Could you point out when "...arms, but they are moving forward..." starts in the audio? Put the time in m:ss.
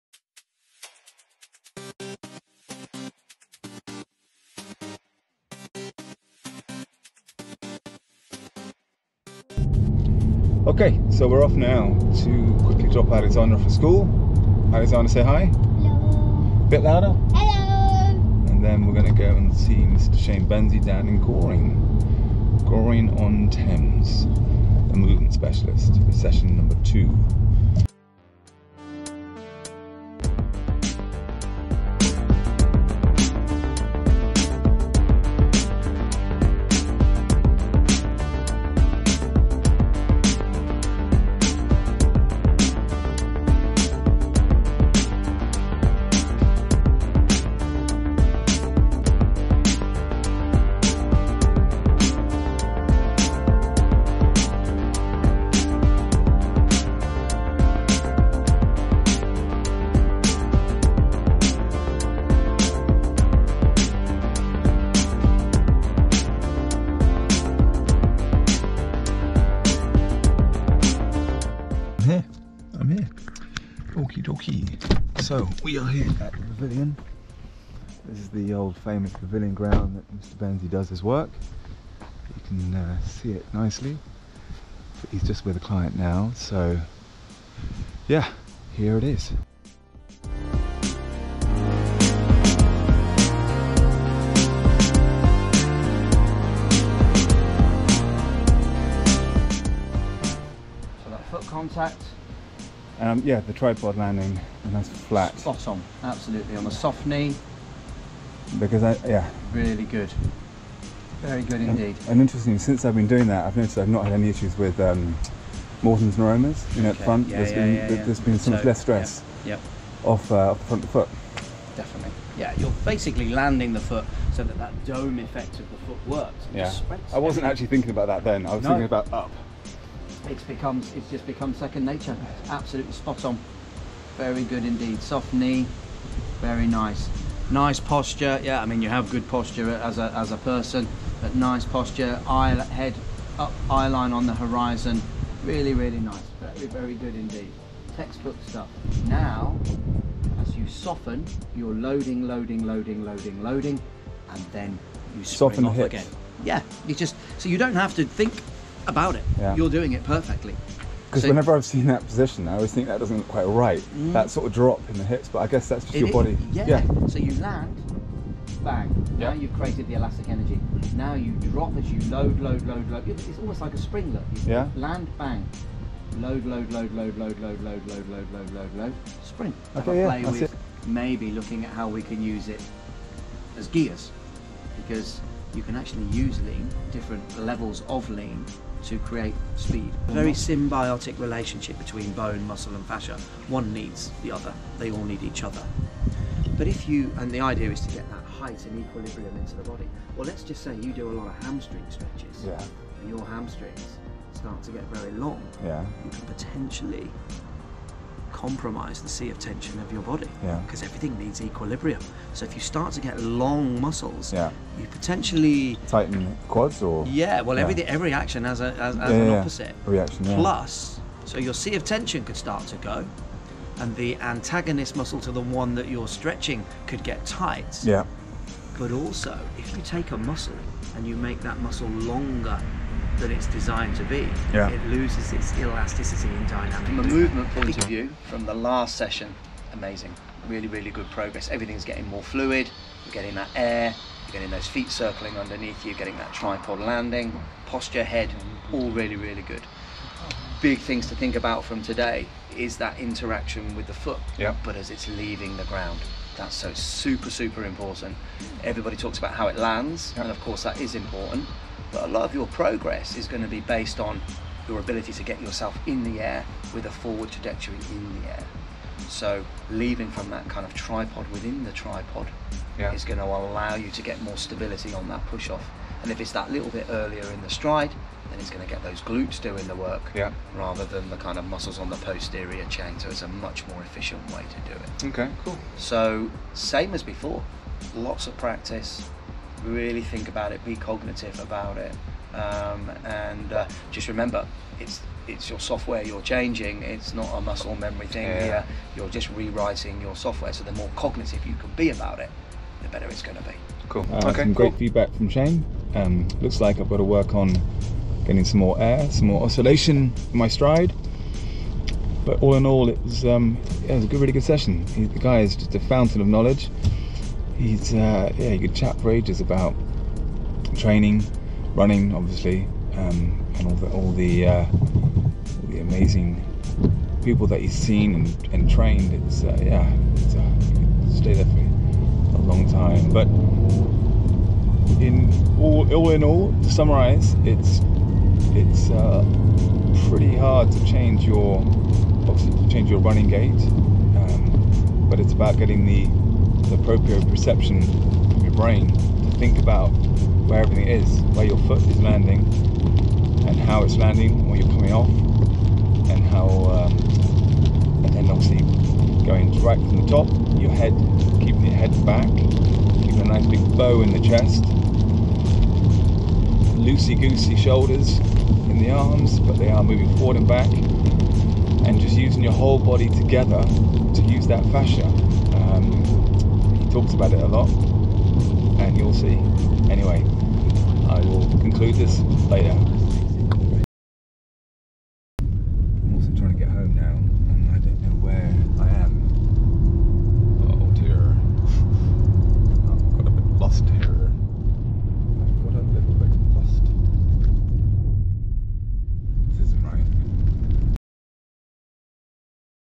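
6:08.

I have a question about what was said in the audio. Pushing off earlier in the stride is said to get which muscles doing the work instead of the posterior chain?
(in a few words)
Glutes.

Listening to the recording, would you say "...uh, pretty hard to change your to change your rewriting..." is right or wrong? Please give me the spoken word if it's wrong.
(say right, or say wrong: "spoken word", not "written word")
wrong: "running", not "rewriting".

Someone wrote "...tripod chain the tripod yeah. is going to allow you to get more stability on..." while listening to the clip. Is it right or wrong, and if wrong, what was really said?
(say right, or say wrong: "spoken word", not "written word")
wrong: "within", not "chain".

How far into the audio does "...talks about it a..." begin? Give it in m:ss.
6:16.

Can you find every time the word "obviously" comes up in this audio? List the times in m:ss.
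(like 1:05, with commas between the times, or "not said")
5:22, 5:58.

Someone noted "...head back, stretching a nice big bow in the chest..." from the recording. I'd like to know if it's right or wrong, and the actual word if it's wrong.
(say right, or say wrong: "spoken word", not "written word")
wrong: "keeping", not "stretching".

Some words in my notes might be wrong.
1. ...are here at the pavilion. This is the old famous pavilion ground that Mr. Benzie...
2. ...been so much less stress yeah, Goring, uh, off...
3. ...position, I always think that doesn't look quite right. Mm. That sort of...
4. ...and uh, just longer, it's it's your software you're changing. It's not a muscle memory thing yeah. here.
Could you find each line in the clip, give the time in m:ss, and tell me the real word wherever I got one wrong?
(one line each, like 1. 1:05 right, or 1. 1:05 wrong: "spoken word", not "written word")
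1. 1:15 right
2. 1:58 wrong: "Off", not "Goring"
3. 2:42 right
4. 4:53 wrong: "remember", not "longer".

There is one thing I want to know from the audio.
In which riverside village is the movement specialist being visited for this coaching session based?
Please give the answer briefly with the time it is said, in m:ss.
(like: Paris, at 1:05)
Goring on Thames, at 0:22.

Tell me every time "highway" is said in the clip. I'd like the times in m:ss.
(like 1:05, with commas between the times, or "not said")
not said.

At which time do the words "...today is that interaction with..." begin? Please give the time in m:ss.
4:11.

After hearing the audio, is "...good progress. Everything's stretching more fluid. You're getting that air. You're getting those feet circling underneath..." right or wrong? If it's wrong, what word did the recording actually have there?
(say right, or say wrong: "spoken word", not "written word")
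wrong: "getting", not "stretching".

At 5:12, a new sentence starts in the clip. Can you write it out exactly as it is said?
But all in all, it was, um, it was a good, really good session.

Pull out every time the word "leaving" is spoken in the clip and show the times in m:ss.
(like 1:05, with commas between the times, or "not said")
4:15, 4:29.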